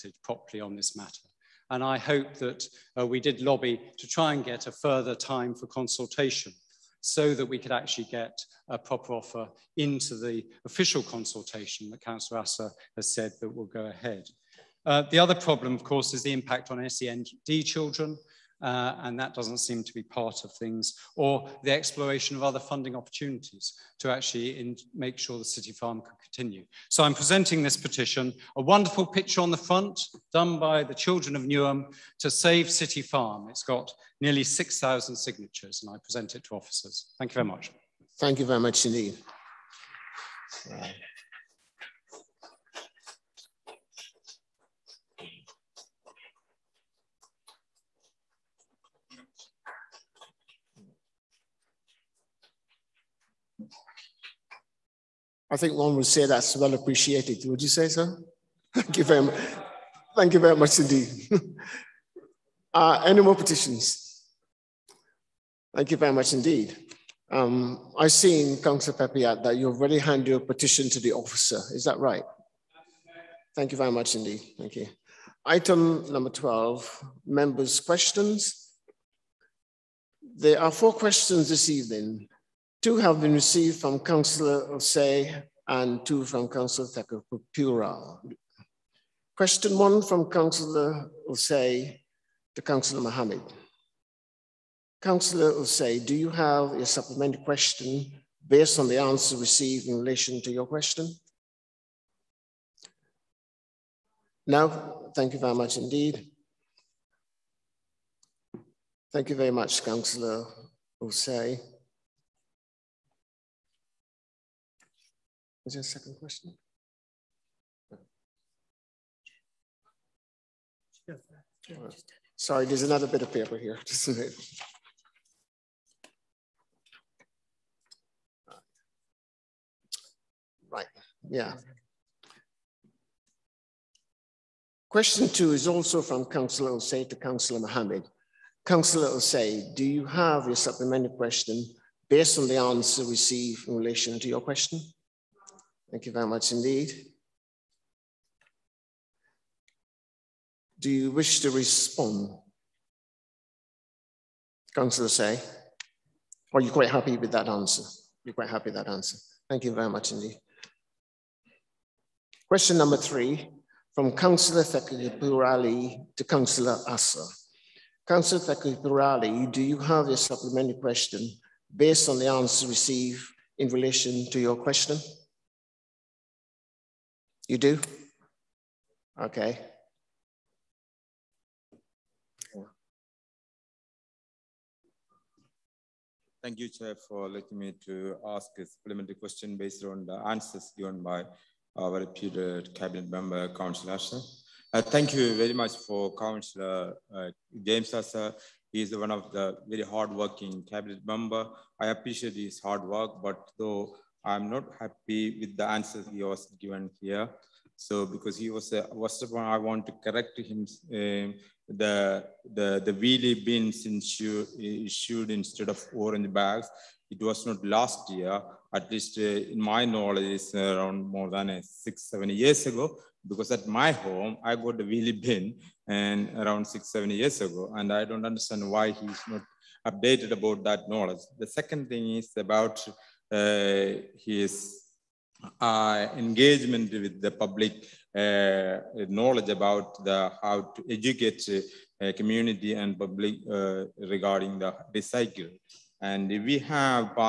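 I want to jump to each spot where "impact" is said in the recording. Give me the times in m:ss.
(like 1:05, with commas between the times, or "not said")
0:16.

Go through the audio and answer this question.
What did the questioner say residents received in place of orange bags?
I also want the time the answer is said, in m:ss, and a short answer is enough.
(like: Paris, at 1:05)
wheelie bins, at 3:32.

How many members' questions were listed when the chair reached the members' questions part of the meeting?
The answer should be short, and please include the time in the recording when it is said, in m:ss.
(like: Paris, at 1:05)
4, at 1:20.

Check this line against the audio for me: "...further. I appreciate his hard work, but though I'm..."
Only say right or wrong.
wrong.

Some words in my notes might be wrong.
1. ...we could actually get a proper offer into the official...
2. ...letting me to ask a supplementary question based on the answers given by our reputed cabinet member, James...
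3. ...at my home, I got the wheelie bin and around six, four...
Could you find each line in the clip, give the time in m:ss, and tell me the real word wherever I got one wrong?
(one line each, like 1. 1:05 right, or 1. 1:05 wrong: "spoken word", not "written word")
1. 0:07 right
2. 3:07 wrong: "Councillor", not "James"
3. 3:43 wrong: "seven", not "four".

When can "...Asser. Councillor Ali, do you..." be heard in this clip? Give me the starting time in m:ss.
2:46.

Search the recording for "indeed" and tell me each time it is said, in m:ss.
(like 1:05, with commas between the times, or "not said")
0:38, 1:00, 1:06, 1:14, 1:45, 2:26, 2:40.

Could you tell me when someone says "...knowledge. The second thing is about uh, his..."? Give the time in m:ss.
3:50.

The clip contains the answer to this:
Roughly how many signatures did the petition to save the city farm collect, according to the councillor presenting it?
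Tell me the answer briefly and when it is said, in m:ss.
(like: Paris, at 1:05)
nearly 6,000, at 0:34.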